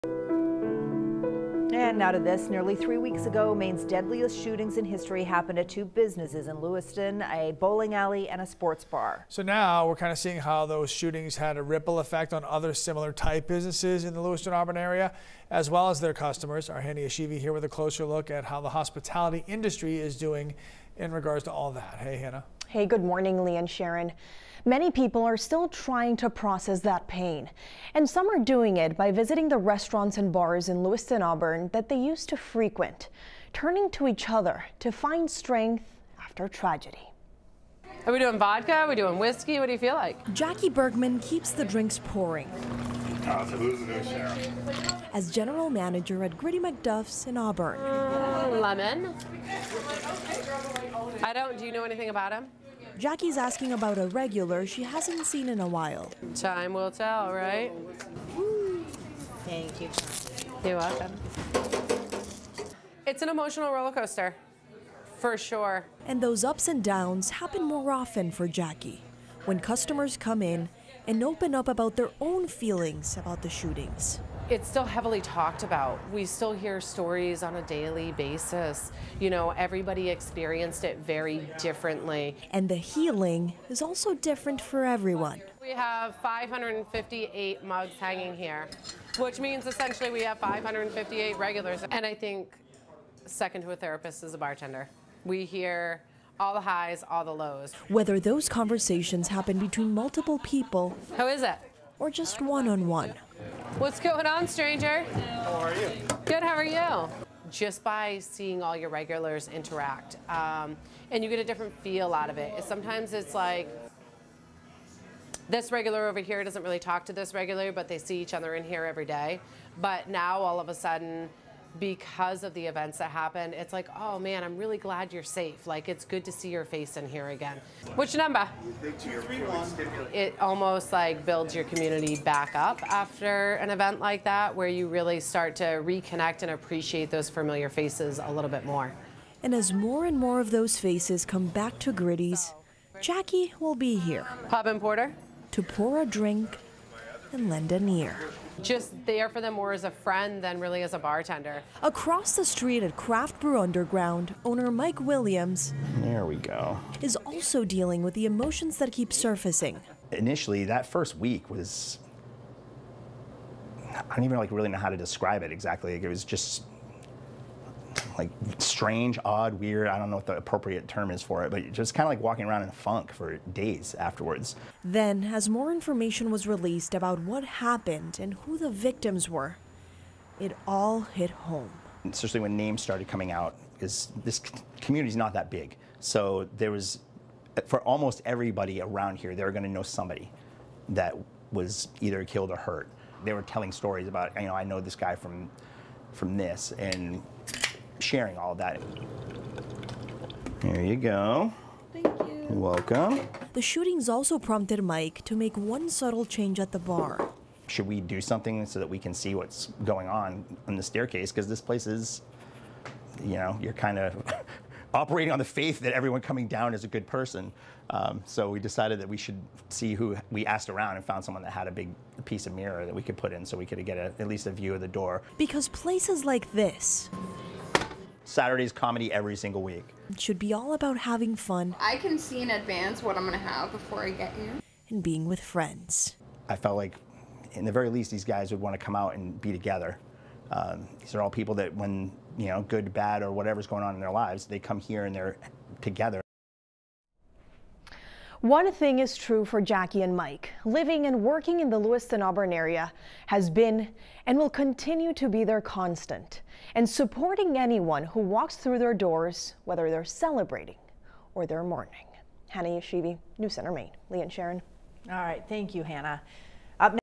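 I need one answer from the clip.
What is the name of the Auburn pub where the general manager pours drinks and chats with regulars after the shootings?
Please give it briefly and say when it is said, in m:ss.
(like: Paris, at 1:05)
Gritty McDuff's, at 0:46.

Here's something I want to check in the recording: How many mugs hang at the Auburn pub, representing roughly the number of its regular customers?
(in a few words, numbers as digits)
558.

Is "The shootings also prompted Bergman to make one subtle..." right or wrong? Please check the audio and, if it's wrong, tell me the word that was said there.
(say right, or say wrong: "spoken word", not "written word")
wrong: "Mike", not "Bergman".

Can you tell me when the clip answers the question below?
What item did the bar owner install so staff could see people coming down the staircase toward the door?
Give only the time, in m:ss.
3:42.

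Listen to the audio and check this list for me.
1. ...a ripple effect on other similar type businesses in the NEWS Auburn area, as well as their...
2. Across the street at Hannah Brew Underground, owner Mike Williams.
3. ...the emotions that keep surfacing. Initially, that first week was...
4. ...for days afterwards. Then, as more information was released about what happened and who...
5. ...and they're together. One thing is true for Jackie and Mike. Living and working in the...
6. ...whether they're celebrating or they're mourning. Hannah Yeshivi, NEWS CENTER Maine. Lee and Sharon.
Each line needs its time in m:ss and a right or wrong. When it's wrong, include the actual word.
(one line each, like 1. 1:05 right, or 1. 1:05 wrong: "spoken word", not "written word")
1. 0:11 wrong: "Lewiston", not "NEWS"
2. 2:31 wrong: "Craft", not "Hannah"
3. 2:38 right
4. 2:53 right
5. 4:05 right
6. 4:19 right.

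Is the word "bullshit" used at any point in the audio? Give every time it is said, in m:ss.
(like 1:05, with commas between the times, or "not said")
not said.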